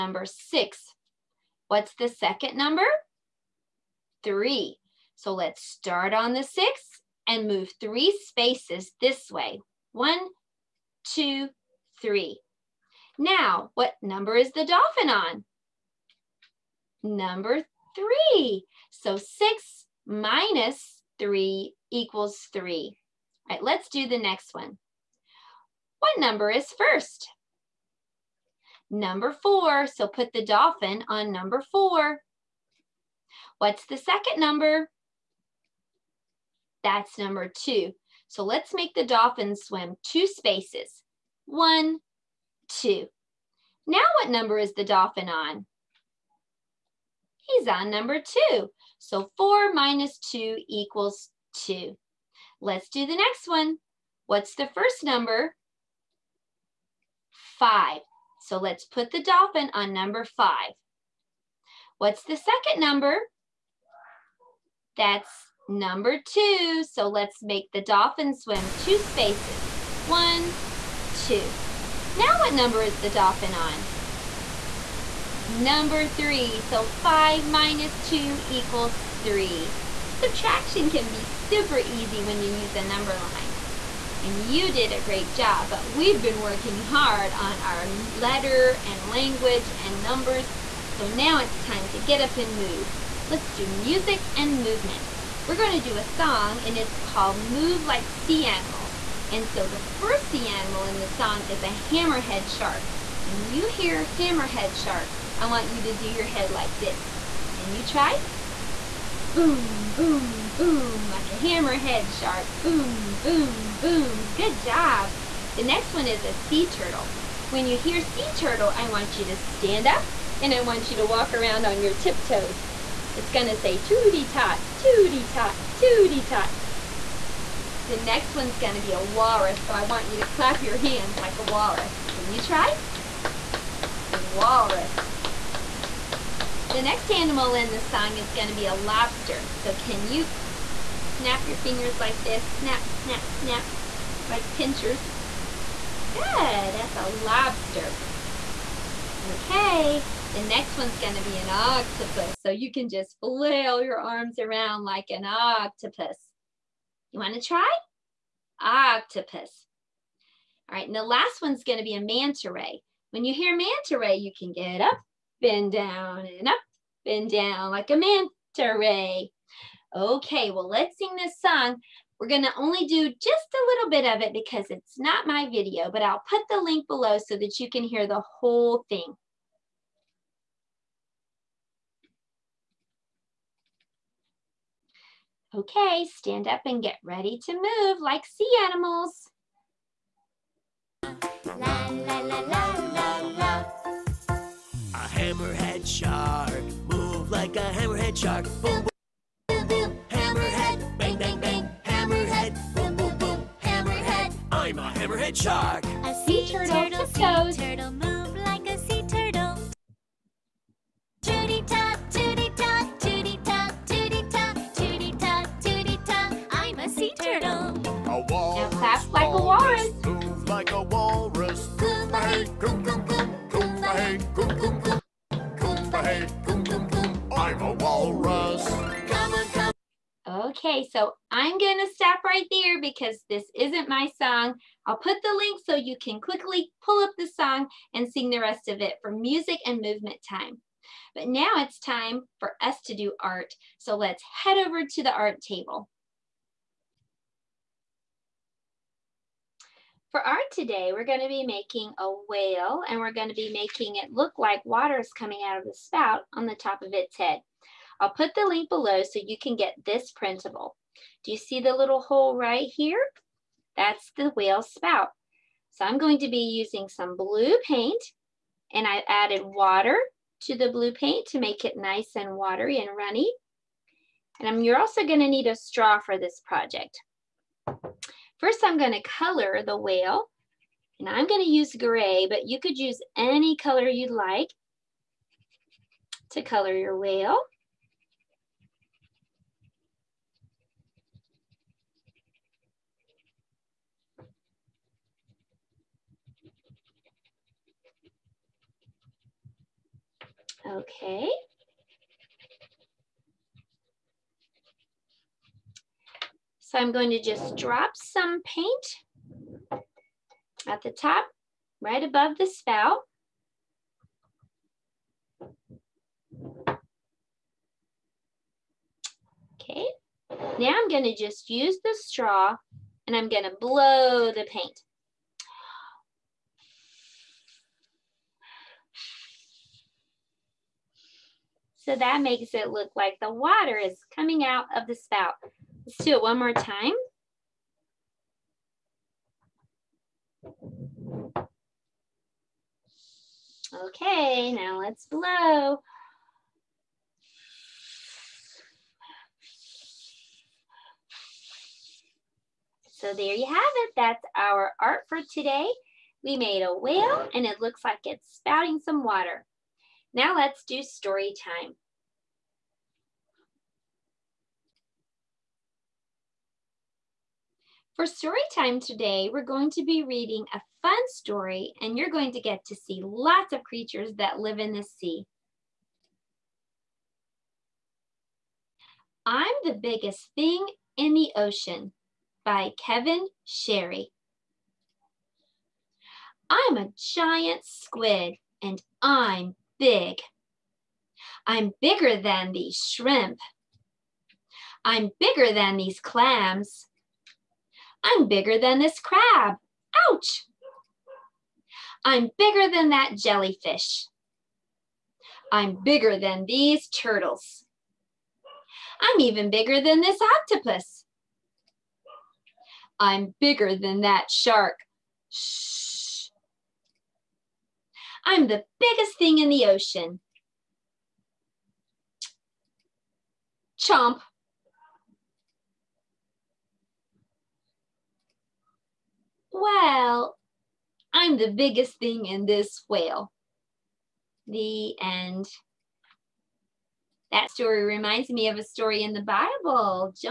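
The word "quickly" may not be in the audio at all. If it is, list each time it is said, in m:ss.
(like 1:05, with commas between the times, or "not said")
3:56.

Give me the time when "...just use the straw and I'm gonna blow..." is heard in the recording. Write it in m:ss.
5:21.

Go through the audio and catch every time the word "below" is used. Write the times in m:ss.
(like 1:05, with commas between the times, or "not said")
2:56, 4:18.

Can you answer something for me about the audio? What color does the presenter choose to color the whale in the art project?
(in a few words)
Gray.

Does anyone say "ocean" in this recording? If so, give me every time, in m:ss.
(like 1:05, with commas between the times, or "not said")
6:21, 6:59.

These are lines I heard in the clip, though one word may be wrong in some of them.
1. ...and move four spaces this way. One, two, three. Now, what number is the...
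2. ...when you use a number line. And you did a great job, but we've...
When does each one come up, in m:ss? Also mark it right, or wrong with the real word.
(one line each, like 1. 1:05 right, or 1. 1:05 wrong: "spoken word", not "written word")
1. 0:07 wrong: "three", not "four"
2. 1:22 right.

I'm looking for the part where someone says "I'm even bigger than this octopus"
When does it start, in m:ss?
6:49.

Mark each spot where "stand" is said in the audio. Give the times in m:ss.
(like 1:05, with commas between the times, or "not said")
1:59, 3:06.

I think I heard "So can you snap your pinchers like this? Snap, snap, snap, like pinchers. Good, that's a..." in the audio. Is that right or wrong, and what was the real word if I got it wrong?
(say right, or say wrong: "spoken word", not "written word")
wrong: "fingers", not "pinchers".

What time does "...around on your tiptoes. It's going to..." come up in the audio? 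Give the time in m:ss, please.
2:01.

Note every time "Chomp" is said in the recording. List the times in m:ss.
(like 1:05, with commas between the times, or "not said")
7:03.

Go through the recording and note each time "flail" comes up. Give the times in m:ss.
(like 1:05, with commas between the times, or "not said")
2:33.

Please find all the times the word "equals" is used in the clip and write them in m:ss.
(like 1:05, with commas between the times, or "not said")
0:21, 0:50, 1:18.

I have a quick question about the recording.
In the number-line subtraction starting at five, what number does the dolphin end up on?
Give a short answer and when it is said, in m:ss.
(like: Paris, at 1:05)
3, at 1:15.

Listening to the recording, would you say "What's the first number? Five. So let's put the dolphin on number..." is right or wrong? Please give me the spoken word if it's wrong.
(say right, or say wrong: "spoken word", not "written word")
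right.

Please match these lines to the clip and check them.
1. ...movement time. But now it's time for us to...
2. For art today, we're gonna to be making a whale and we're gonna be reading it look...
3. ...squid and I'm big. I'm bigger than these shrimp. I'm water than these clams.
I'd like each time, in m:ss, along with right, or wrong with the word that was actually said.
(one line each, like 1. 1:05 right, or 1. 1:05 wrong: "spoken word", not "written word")
1. 3:59 right
2. 4:10 wrong: "making", not "reading"
3. 6:27 wrong: "bigger", not "water".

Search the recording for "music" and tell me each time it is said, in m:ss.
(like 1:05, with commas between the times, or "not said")
1:33, 3:59.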